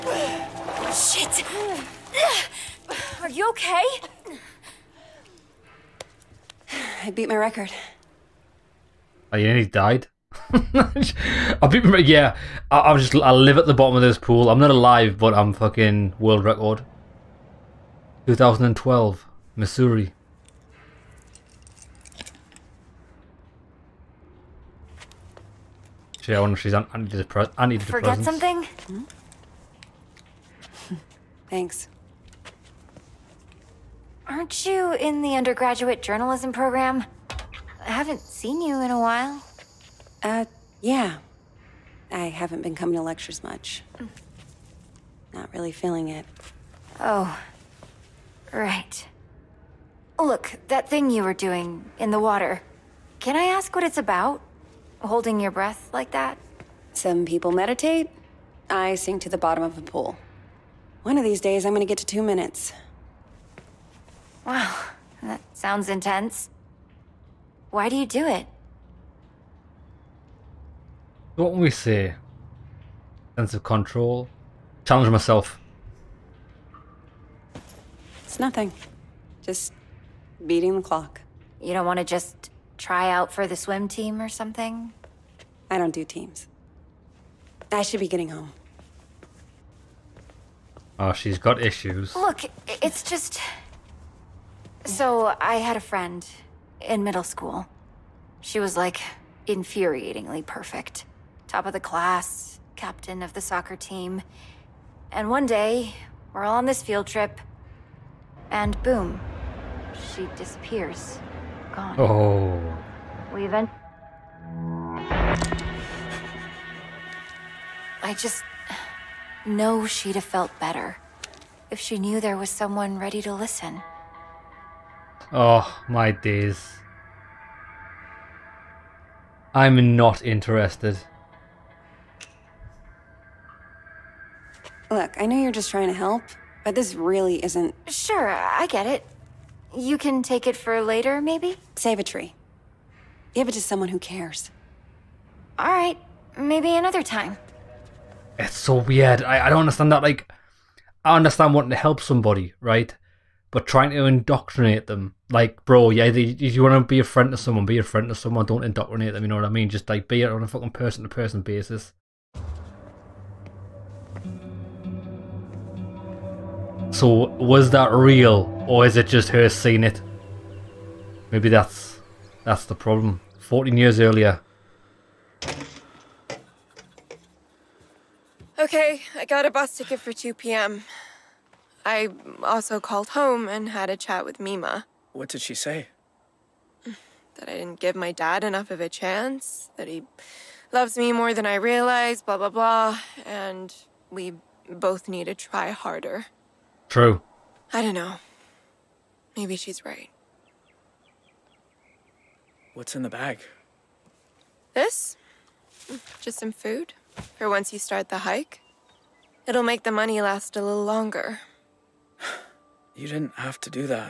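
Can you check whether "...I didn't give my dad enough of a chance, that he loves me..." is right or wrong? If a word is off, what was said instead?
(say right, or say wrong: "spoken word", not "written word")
right.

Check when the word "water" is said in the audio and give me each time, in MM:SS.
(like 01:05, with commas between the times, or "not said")
00:52.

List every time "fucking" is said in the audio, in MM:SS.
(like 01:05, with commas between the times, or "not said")
00:15, 02:40.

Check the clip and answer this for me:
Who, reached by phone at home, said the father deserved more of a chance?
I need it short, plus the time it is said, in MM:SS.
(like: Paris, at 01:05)
Mima, at 03:04.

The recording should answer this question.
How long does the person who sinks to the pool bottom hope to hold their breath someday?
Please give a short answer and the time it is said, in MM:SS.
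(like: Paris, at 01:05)
2 minutes, at 01:02.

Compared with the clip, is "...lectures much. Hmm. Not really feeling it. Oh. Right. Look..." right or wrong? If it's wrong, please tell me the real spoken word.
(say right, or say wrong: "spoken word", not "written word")
right.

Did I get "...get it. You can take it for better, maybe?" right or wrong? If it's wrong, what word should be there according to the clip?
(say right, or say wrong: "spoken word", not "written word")
wrong: "later", not "better".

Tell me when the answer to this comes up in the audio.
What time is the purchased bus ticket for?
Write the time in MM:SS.
03:00.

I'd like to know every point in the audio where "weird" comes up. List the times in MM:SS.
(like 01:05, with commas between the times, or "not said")
02:28.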